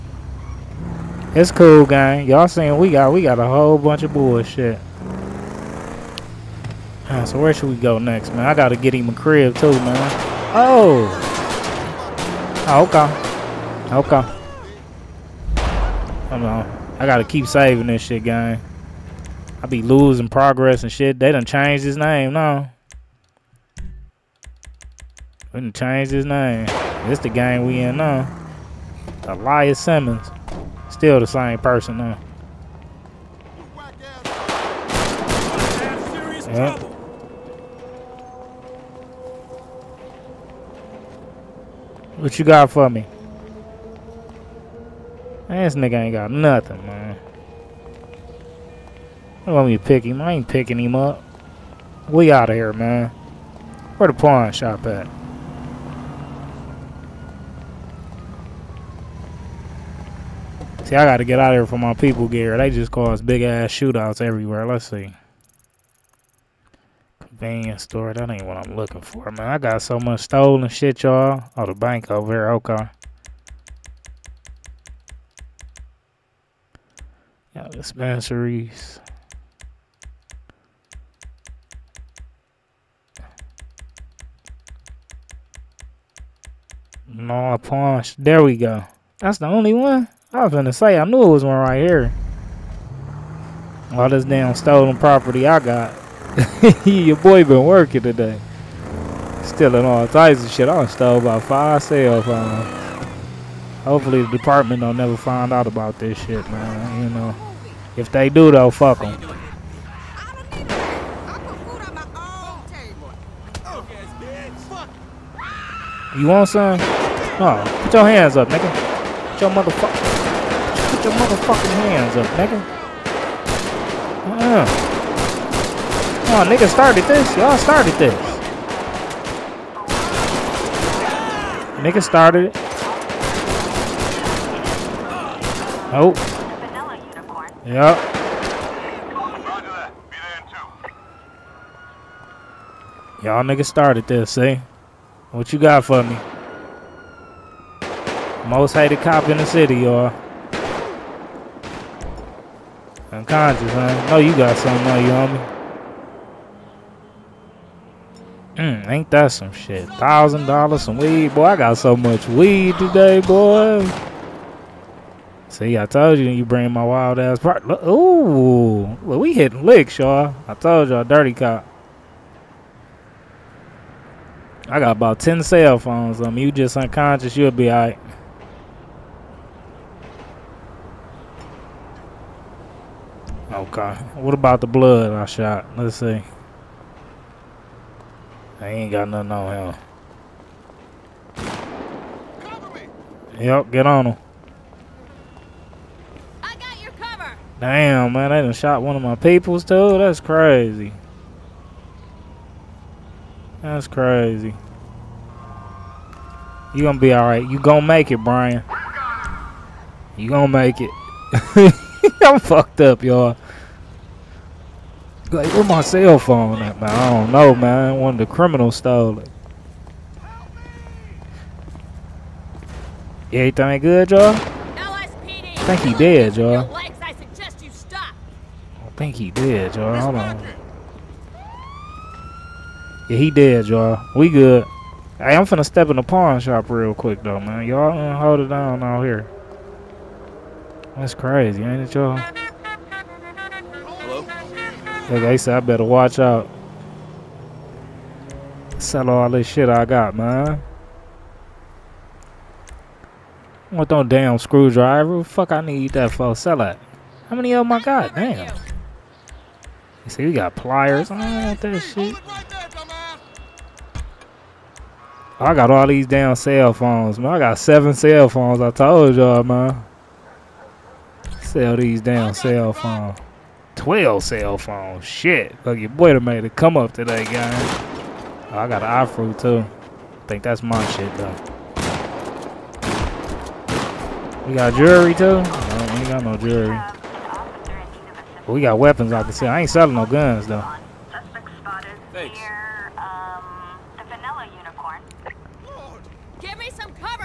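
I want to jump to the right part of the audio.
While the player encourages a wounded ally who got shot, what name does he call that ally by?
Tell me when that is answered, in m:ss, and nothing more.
3:28.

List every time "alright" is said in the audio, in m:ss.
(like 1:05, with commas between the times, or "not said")
2:57, 3:27.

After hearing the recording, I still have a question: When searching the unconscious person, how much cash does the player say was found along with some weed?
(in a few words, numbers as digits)
$1,000.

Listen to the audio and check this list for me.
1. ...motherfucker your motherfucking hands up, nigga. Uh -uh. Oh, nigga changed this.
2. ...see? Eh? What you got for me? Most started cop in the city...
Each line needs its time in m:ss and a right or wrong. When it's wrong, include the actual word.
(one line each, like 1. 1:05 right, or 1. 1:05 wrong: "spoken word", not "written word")
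1. 1:59 wrong: "started", not "changed"
2. 2:24 wrong: "hated", not "started".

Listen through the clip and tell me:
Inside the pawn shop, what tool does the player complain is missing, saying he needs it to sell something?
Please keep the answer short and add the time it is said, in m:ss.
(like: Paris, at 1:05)
Screwdriver, at 4:14.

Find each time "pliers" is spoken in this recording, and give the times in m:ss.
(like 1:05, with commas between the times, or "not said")
4:20.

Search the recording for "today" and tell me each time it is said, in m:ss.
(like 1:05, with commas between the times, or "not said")
1:38, 2:42, 4:36.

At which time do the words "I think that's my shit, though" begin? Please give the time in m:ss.
4:39.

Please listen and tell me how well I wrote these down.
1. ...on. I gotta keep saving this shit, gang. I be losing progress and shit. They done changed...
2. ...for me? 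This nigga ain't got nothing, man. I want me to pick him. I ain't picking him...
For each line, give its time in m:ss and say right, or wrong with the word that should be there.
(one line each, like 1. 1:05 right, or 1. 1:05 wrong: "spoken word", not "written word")
1. 0:16 right
2. 0:42 right.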